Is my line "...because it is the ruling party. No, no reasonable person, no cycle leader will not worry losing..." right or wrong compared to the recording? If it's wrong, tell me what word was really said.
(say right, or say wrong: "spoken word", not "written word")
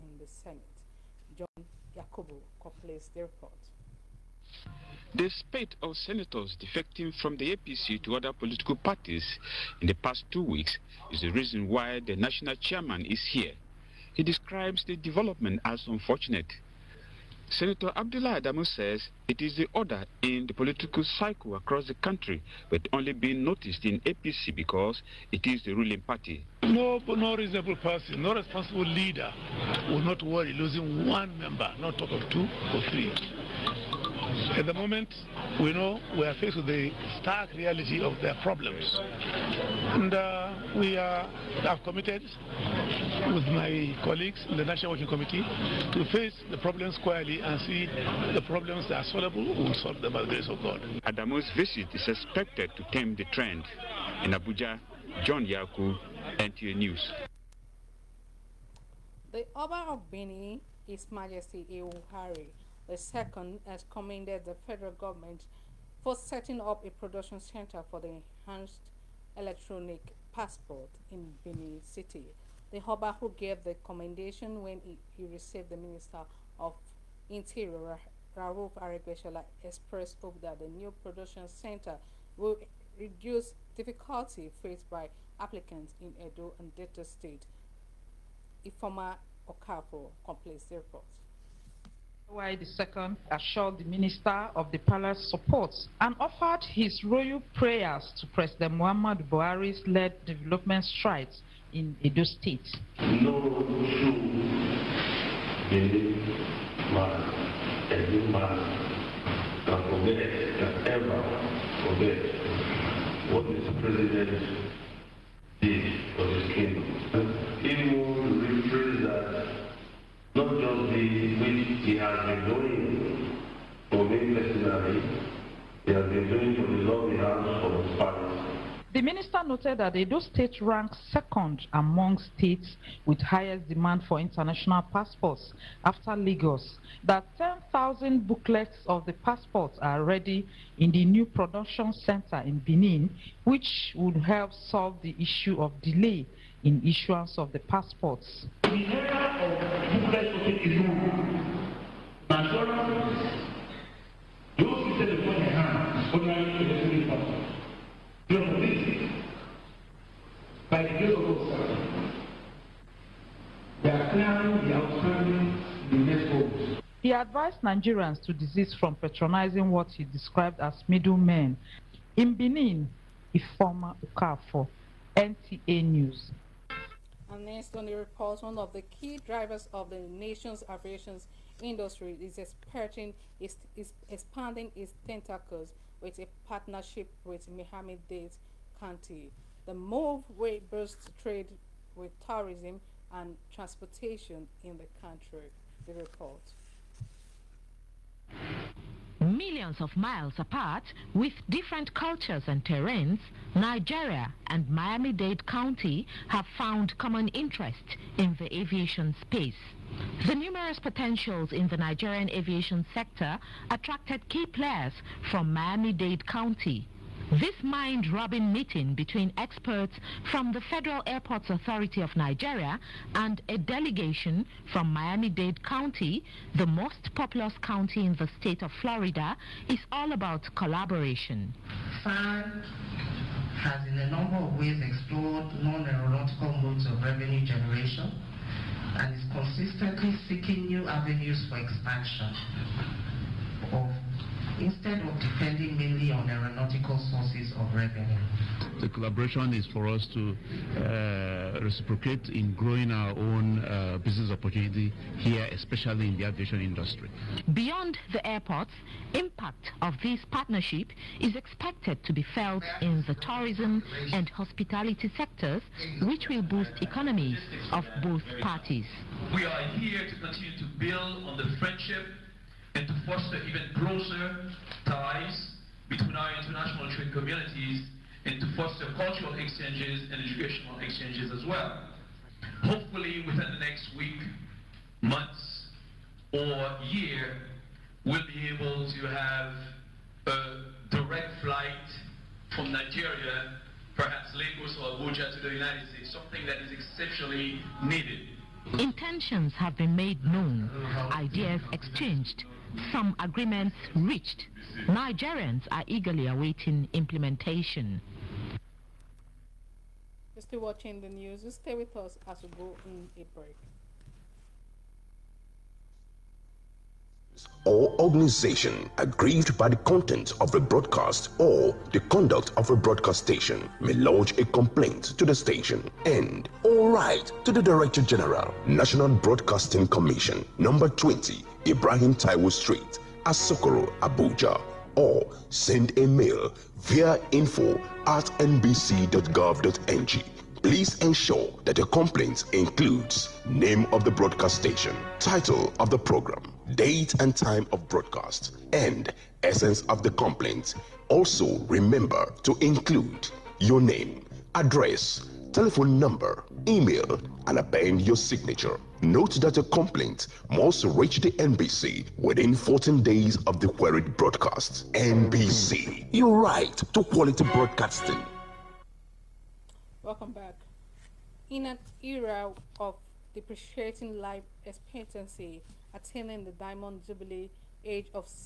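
wrong: "responsible", not "cycle".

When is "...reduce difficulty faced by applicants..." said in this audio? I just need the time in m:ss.
1:22.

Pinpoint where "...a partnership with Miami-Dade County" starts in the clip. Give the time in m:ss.
3:06.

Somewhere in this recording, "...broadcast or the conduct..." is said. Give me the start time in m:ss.
5:20.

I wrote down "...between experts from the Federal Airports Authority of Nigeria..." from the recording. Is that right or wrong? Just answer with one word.
right.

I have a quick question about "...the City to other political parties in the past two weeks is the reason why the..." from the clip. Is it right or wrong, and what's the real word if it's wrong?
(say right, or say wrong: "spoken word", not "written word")
wrong: "APC", not "City".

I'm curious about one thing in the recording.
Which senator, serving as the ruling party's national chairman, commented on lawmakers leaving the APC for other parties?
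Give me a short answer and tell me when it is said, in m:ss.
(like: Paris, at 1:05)
Abdullah Adamu, at 0:17.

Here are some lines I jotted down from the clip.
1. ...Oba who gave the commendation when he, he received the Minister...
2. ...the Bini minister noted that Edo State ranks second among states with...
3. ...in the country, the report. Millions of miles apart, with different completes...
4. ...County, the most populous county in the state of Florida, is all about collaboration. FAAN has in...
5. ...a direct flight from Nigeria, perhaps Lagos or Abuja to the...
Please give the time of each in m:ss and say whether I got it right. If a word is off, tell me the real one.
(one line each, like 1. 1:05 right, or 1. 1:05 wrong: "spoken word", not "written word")
1. 1:12 right
2. 2:06 wrong: "The", not "Bini"
3. 3:14 wrong: "cultures", not "completes"
4. 3:45 right
5. 4:50 right.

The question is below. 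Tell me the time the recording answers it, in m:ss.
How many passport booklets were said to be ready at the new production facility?
2:17.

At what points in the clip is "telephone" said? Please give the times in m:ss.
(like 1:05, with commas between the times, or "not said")
5:55.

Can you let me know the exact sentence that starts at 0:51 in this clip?
Adamu's visit is expected to tame the trend.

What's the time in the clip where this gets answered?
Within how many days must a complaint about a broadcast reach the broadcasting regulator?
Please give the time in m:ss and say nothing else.
6:02.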